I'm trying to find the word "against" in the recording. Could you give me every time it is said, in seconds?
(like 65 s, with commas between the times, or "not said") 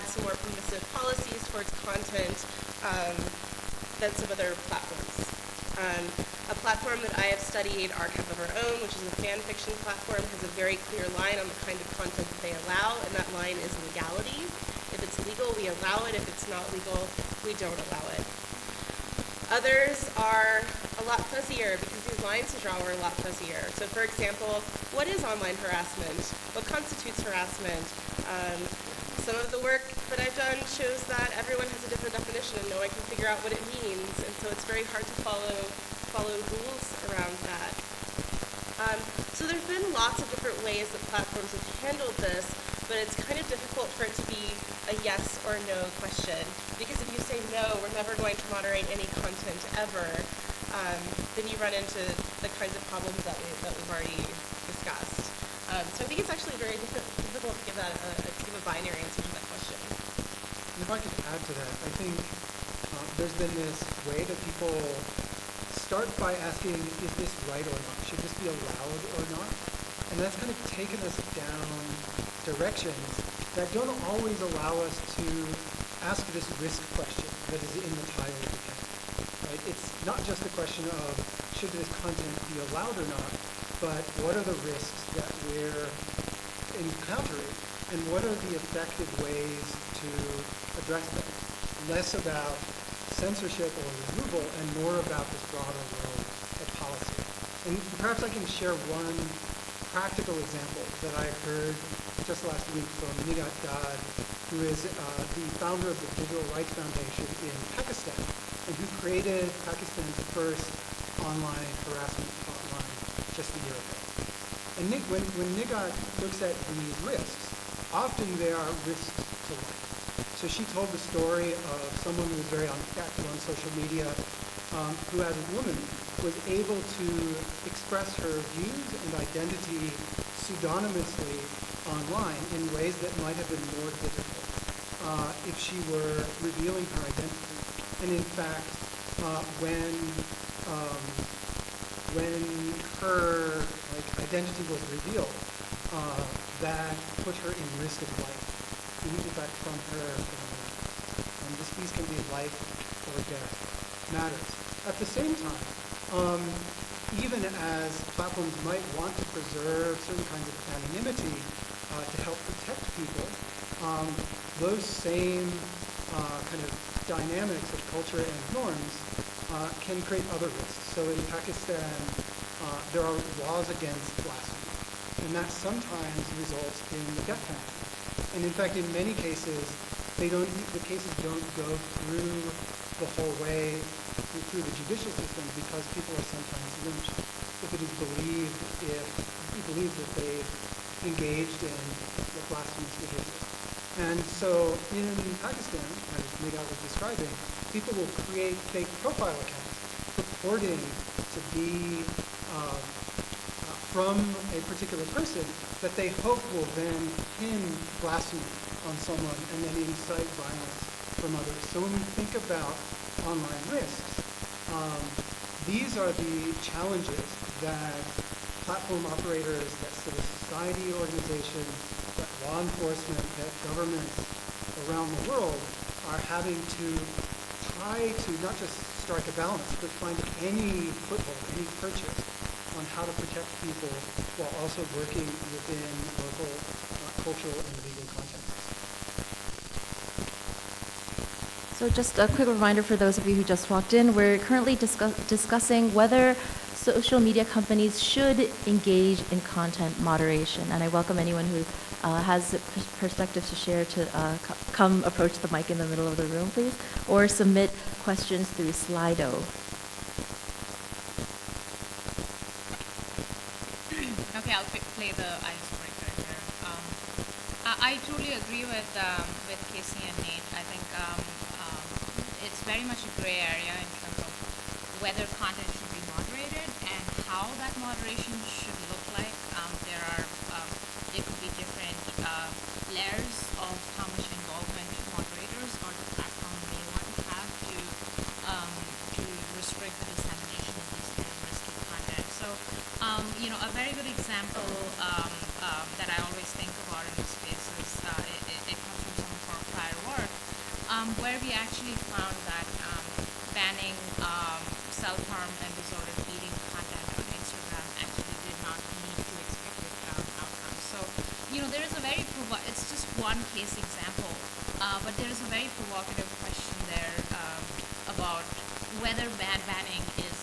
173 s.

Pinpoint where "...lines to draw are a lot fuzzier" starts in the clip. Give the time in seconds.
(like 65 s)
22 s.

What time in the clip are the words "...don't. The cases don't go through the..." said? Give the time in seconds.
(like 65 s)
180 s.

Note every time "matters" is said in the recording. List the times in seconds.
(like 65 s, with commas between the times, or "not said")
154 s.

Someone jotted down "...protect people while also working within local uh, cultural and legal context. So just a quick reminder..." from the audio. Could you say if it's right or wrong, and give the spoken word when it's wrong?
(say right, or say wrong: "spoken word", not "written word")
right.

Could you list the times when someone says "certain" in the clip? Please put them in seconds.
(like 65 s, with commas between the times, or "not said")
160 s.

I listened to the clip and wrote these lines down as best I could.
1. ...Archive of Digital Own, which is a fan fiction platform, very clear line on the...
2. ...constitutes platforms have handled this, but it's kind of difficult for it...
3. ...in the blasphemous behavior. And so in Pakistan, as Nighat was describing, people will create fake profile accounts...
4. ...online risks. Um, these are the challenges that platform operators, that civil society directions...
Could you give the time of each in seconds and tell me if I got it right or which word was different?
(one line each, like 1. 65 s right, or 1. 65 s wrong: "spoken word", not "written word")
1. 7 s wrong: "Our", not "Digital"
2. 36 s wrong: "rules", not "constitutes"
3. 191 s right
4. 213 s wrong: "organizations", not "directions".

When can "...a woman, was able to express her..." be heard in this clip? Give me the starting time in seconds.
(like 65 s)
125 s.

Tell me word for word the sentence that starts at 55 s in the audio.
Um, so I think it's actually very difficult to give that a, a, give a binary answer to that question.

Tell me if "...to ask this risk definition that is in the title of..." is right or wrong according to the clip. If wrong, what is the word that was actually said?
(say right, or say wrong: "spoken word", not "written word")
wrong: "question", not "definition".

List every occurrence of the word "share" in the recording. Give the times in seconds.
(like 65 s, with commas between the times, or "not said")
98 s, 253 s.